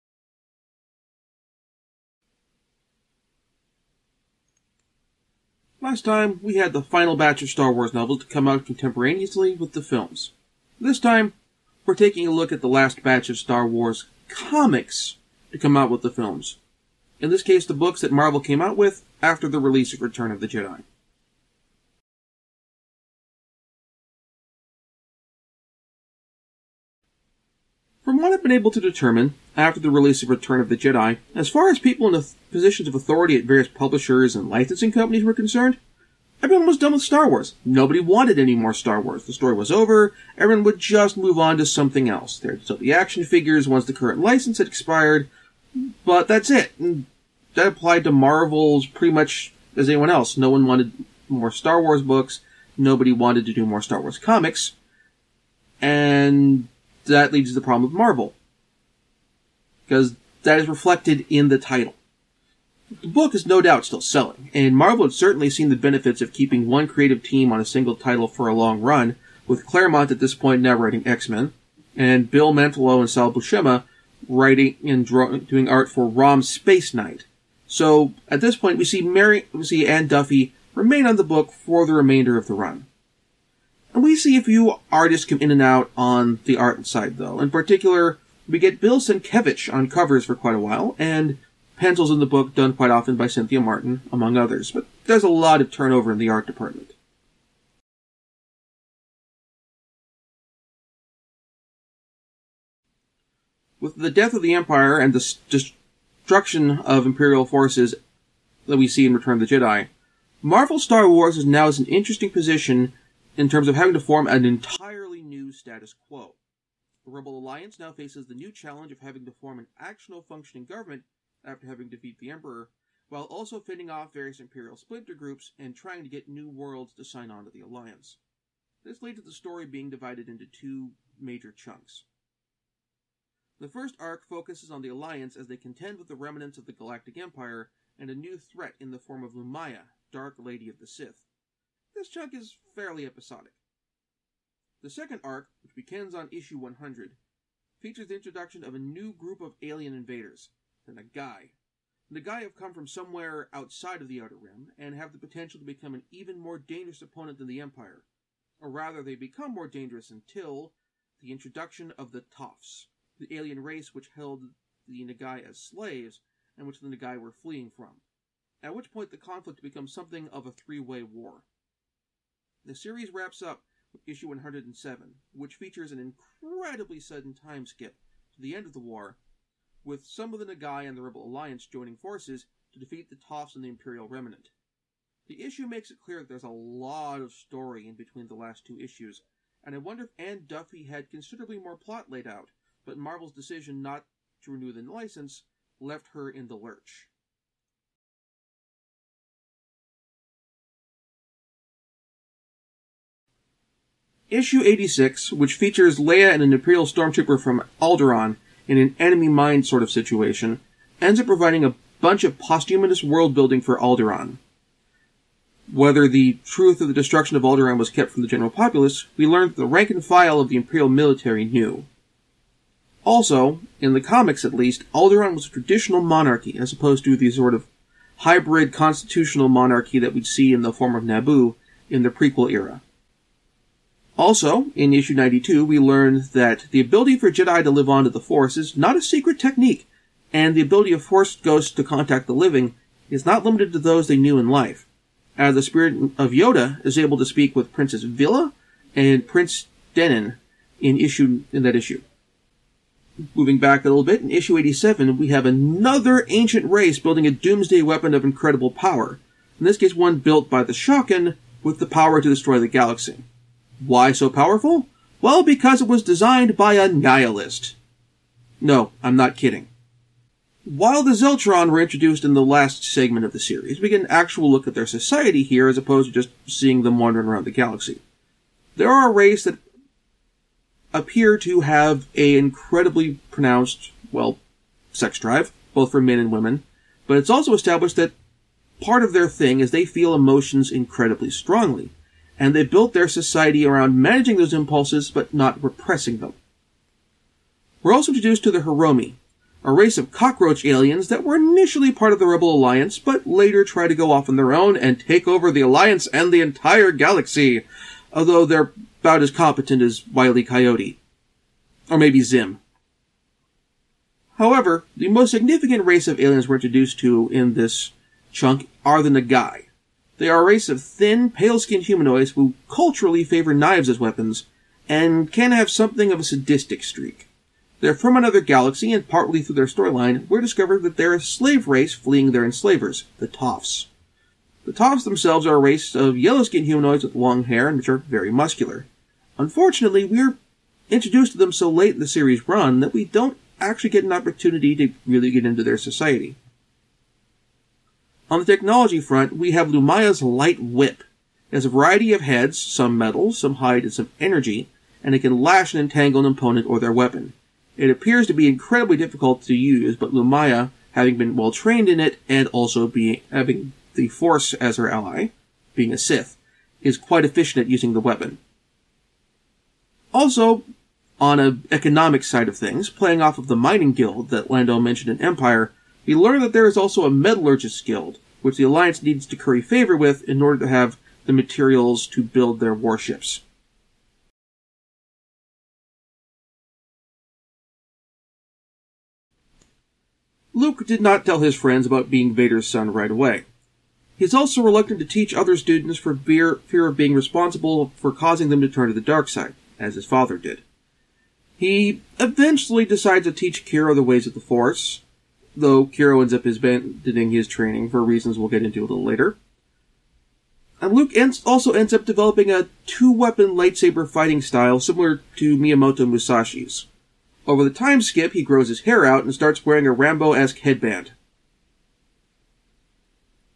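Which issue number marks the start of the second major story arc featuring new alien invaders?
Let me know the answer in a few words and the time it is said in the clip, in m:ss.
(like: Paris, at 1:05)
100, at 2:26.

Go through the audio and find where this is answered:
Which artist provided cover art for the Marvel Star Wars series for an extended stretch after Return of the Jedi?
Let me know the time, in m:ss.
1:28.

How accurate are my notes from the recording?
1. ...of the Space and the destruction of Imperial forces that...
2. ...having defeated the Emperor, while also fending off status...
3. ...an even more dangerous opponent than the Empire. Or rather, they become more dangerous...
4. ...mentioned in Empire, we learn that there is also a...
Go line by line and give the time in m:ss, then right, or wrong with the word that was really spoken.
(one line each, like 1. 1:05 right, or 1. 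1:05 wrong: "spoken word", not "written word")
1. 1:44 wrong: "Empire", not "Space"
2. 2:01 wrong: "various", not "status"
3. 2:35 right
4. 6:14 right.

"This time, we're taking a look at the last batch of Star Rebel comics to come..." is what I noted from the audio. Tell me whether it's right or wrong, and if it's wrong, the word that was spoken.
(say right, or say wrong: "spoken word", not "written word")
wrong: "Wars", not "Rebel".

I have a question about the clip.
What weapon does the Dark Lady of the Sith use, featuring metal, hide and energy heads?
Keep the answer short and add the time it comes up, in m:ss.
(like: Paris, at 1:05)
Light Whip, at 5:50.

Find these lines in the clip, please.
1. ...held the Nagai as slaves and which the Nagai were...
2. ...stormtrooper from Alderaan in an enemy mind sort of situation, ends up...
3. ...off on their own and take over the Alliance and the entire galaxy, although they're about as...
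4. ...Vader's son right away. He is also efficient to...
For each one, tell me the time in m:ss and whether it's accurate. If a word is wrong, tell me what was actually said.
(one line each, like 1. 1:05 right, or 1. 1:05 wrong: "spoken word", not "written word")
1. 2:44 right
2. 3:26 right
3. 5:04 right
4. 6:32 wrong: "reluctant", not "efficient".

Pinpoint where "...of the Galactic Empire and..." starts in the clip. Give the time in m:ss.
2:16.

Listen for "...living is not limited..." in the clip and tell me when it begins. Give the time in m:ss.
4:02.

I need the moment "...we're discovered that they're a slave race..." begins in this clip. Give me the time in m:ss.
5:30.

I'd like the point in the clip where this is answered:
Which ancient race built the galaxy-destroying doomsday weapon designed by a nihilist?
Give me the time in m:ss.
4:20.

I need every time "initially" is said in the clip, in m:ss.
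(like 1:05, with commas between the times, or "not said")
5:01.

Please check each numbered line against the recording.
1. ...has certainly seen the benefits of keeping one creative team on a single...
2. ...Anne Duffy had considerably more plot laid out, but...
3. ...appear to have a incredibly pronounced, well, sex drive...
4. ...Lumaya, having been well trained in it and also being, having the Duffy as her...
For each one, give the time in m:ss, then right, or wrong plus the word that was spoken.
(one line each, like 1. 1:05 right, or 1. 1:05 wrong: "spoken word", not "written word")
1. 1:05 right
2. 3:10 right
3. 4:40 right
4. 6:00 wrong: "Force", not "Duffy".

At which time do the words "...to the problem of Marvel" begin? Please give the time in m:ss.
0:57.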